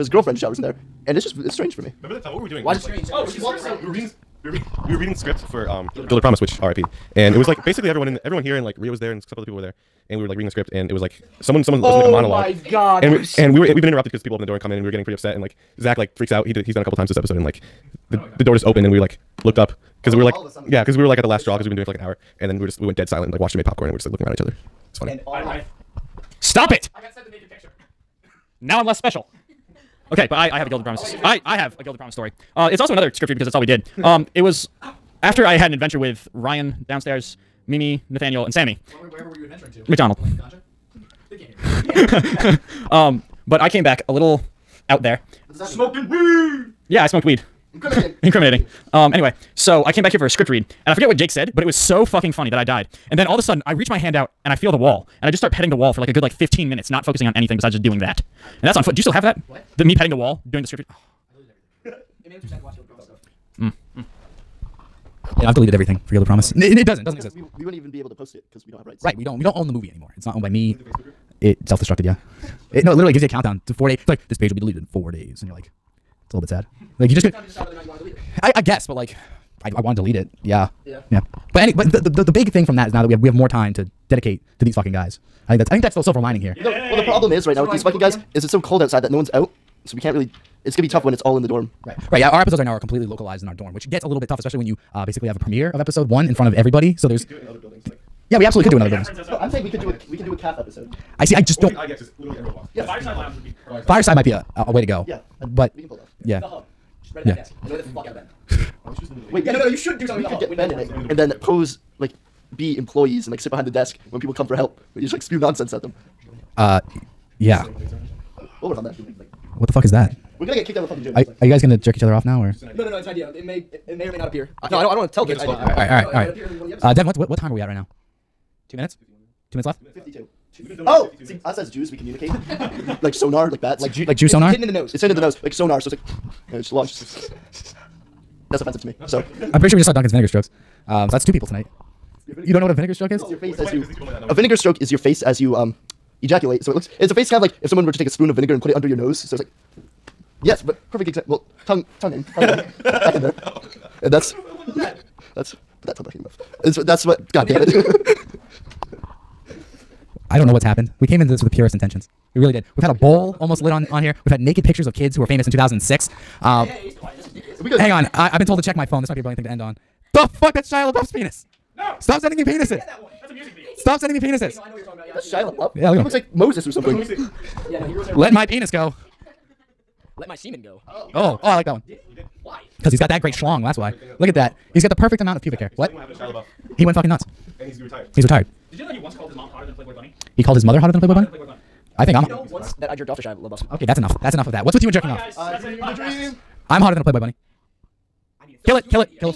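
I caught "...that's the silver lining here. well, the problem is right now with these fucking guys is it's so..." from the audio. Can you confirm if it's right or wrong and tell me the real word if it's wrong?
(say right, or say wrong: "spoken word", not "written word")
right.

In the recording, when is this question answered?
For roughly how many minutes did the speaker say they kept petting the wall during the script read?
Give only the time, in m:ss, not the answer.
0:56.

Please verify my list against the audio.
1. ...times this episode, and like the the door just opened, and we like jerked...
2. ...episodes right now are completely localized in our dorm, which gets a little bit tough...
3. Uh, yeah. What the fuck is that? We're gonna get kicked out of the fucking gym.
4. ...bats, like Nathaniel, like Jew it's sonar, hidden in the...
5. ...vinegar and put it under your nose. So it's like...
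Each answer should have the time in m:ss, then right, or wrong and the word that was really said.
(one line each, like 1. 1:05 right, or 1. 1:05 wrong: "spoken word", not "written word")
1. 0:16 wrong: "looked", not "jerked"
2. 1:32 right
3. 1:56 right
4. 2:13 wrong: "Jew", not "Nathaniel"
5. 2:28 right.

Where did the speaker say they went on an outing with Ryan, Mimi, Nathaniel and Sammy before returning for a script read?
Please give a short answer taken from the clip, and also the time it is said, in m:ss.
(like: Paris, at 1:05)
McDonald's, at 0:39.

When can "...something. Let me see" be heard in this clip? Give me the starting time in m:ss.
2:56.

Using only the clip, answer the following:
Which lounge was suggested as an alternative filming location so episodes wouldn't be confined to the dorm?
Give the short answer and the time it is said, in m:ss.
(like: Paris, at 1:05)
Fireside Lounge, at 1:42.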